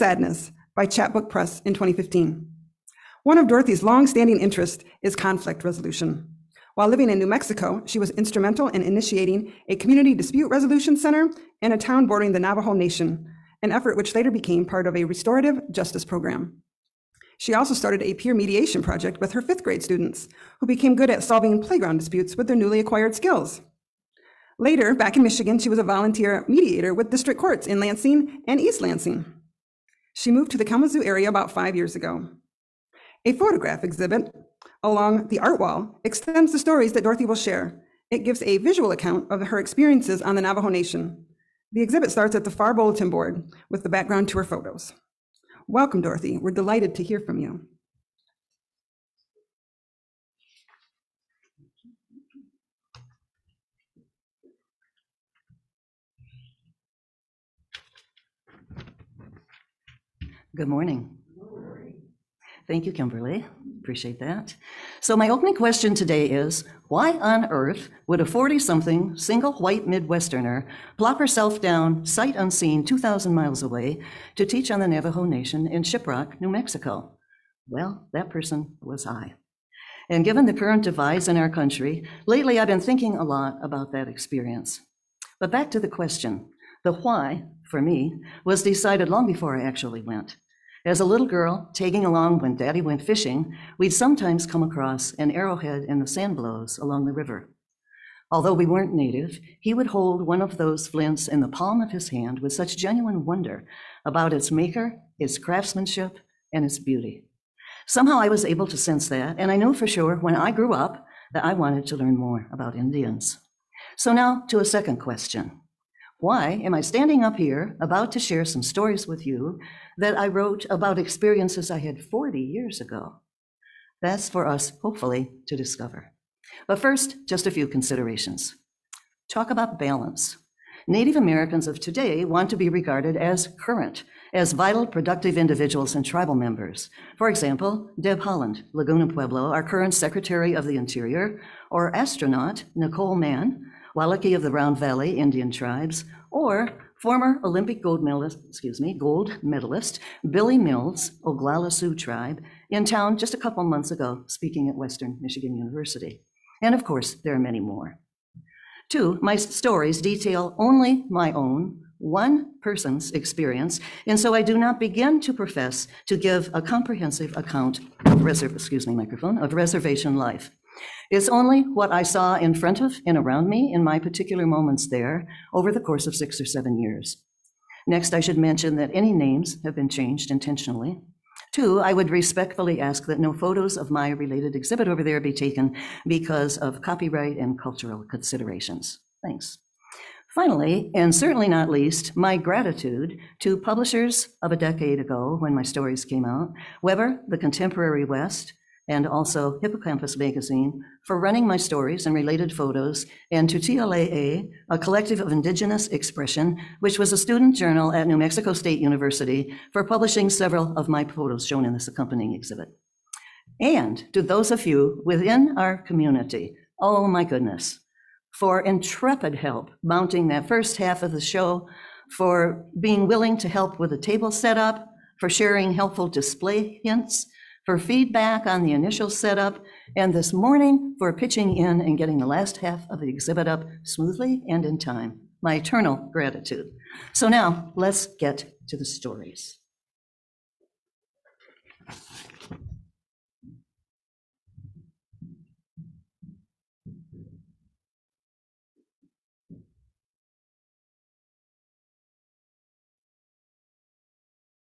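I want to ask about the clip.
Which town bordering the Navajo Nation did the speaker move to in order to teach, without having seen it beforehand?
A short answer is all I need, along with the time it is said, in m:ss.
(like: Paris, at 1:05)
Shiprock, at 1:15.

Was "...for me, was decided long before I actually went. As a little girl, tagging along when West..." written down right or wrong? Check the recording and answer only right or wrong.
wrong.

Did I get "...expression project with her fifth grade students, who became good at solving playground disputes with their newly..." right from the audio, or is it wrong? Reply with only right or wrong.
wrong.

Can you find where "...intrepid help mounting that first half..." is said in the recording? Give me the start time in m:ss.
3:38.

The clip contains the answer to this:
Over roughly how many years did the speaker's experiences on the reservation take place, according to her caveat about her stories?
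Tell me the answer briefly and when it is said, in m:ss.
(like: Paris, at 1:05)
6 or 7 years, at 2:56.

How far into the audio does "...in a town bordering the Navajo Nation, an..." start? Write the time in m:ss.
0:11.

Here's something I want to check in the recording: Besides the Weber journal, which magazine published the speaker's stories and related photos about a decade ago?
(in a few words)
Hippocampus Magazine.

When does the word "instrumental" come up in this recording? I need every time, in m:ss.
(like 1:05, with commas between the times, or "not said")
0:08.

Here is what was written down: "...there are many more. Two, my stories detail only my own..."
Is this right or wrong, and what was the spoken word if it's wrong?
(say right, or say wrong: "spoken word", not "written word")
right.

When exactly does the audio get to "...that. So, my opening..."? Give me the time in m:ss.
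1:04.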